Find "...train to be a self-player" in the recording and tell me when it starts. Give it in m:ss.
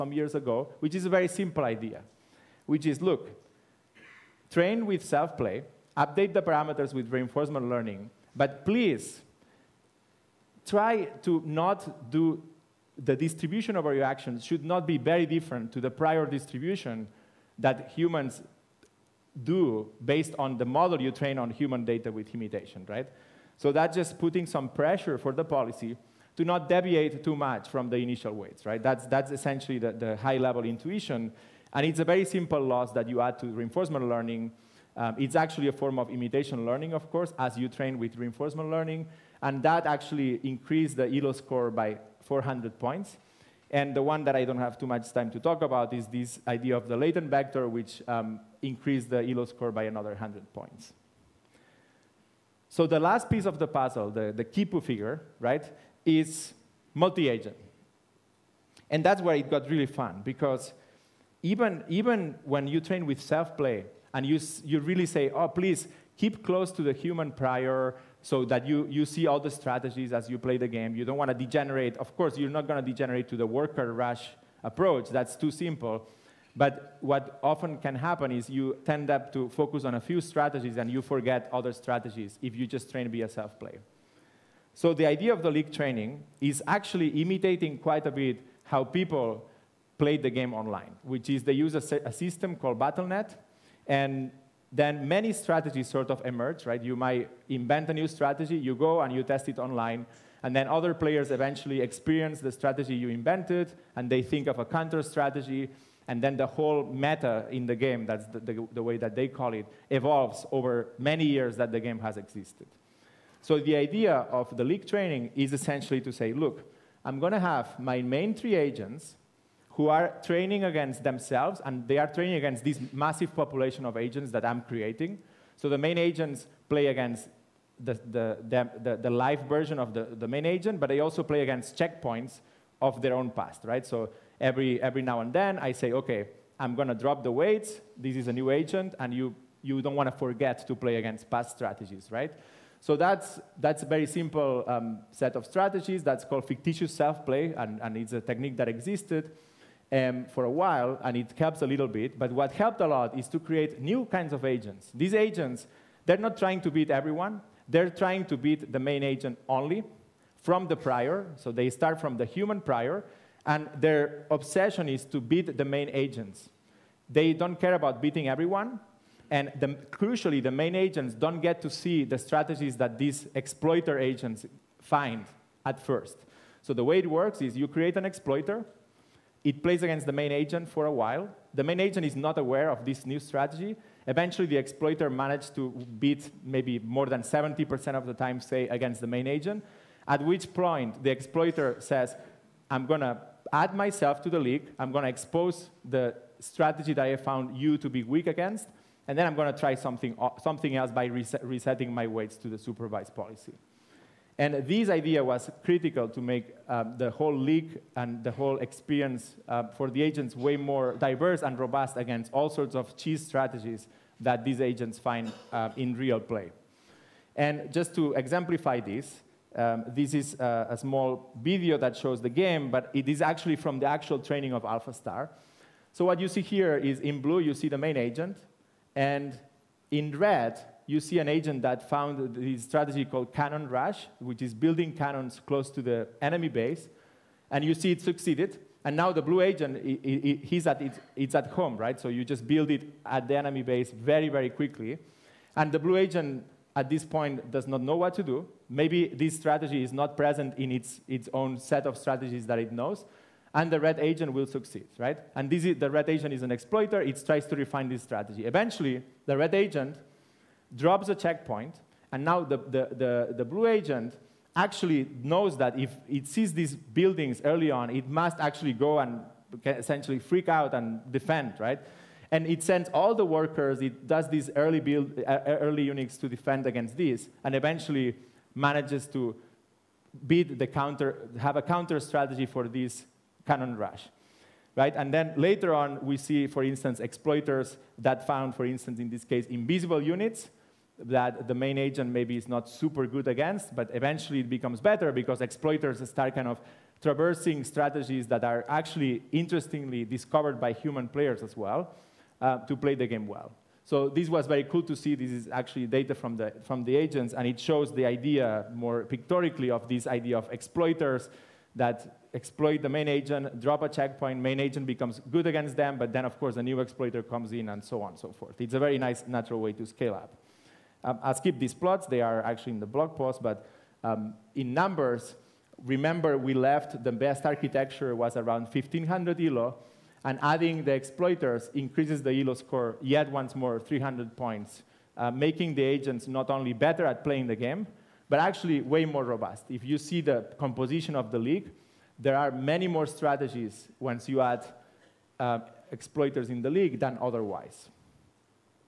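1:22.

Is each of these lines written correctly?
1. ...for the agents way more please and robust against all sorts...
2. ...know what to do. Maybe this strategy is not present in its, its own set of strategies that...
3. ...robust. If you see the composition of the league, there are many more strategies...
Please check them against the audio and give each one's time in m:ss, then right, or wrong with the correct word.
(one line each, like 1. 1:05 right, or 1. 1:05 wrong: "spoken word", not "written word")
1. 3:29 wrong: "diverse", not "please"
2. 4:07 right
3. 5:39 right.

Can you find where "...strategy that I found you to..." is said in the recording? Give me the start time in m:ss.
3:16.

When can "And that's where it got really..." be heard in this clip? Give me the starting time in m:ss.
0:58.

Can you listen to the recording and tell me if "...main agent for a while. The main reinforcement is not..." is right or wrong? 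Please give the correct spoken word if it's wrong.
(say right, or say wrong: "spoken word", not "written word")
wrong: "agent", not "reinforcement".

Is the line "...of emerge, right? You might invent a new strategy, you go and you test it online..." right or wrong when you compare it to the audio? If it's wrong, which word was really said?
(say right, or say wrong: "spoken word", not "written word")
right.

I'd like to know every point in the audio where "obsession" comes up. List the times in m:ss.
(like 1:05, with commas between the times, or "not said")
2:44.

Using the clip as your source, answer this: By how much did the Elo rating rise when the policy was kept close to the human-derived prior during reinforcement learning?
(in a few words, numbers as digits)
400 points.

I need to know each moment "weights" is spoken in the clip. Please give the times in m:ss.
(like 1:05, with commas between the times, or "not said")
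0:28, 2:17, 3:22.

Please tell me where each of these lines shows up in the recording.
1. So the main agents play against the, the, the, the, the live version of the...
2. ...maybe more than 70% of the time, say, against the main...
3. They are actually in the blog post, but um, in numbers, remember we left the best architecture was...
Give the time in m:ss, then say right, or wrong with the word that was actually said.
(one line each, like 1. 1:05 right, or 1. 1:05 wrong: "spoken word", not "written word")
1. 2:05 right
2. 3:06 right
3. 5:22 right.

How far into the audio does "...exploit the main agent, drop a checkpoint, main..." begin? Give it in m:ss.
5:12.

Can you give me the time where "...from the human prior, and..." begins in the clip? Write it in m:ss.
2:41.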